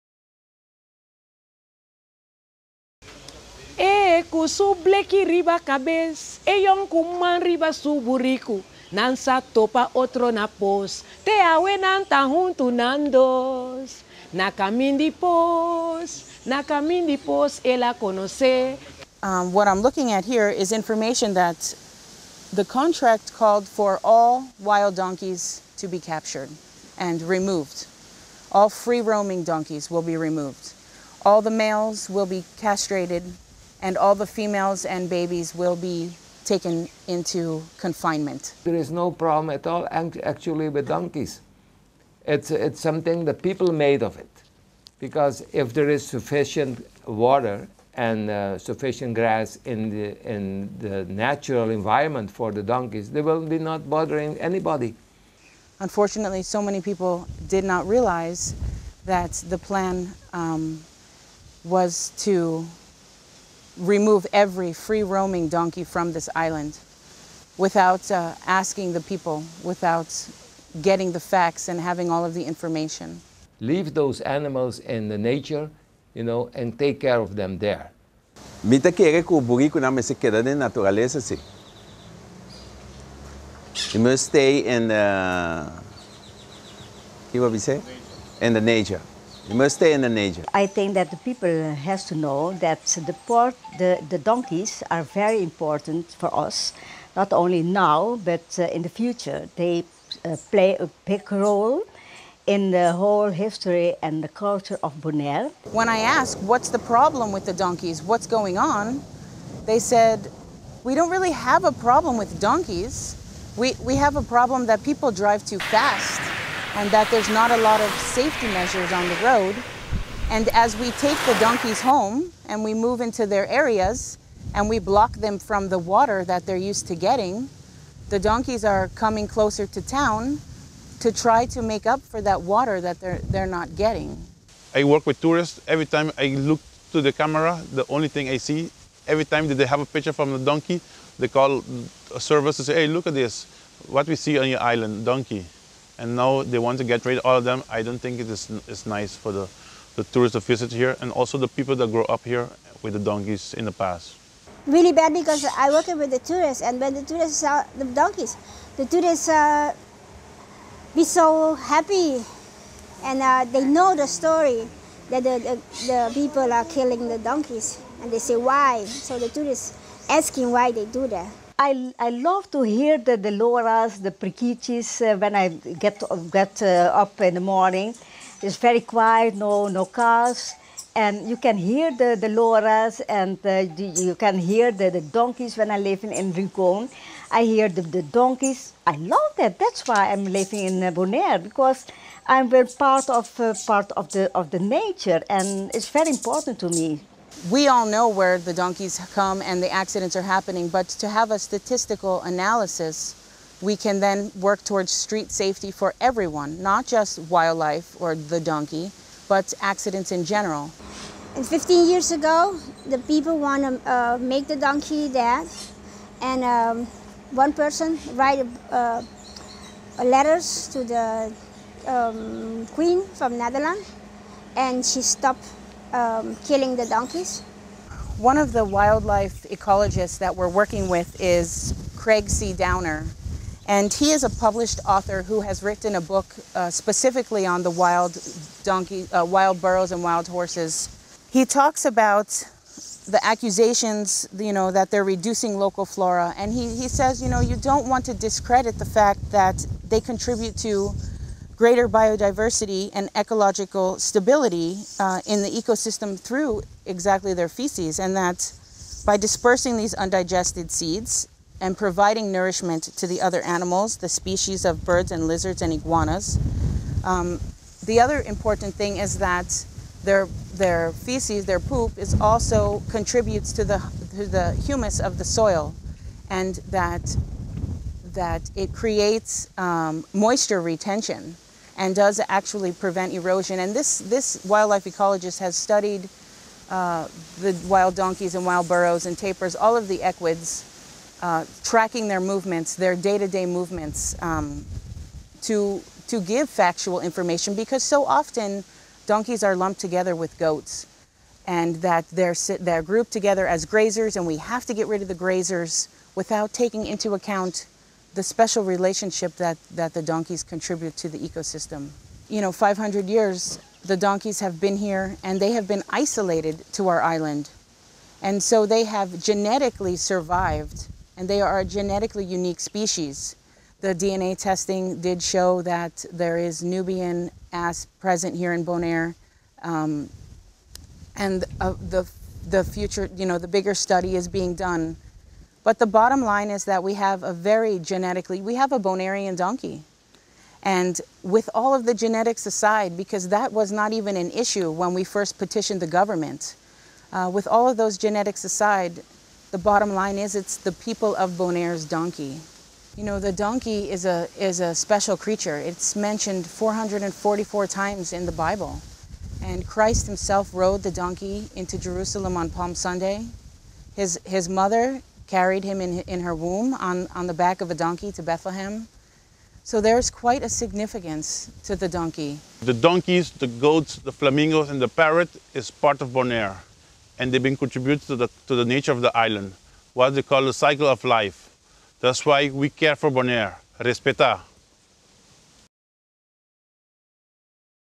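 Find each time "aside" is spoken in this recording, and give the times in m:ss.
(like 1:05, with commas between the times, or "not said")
5:42, 5:48.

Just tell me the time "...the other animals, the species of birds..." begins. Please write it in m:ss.
4:23.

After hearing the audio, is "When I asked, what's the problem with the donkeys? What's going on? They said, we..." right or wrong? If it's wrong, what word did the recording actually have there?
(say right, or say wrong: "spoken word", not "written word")
right.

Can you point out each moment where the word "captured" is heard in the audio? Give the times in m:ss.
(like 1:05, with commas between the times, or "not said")
0:25.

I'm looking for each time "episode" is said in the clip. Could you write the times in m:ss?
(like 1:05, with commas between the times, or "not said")
not said.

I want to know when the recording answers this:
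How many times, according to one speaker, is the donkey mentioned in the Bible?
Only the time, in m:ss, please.
5:56.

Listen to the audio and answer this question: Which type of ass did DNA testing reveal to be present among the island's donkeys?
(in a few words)
Nubian ass.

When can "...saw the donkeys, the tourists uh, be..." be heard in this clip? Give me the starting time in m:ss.
2:37.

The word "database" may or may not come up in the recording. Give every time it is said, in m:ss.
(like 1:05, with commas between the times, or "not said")
not said.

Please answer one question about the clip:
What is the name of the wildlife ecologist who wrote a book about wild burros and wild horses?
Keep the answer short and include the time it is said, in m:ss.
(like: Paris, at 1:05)
Craig C. Downer, at 3:51.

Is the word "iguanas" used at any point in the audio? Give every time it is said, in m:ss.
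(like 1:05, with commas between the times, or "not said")
4:25.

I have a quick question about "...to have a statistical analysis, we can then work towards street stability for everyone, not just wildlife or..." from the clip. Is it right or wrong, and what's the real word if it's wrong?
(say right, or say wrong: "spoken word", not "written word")
wrong: "safety", not "stability".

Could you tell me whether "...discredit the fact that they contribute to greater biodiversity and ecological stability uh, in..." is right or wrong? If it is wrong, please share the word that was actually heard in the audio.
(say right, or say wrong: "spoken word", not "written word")
right.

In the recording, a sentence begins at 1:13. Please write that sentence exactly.
Leave those animals in the nature, you know, and take care of them there.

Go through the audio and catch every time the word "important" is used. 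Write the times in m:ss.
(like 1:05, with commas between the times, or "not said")
1:35, 3:16, 4:28.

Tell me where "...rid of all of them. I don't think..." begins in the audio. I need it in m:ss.
2:27.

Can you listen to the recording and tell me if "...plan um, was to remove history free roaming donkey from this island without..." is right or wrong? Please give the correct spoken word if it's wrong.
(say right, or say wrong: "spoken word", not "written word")
wrong: "every", not "history".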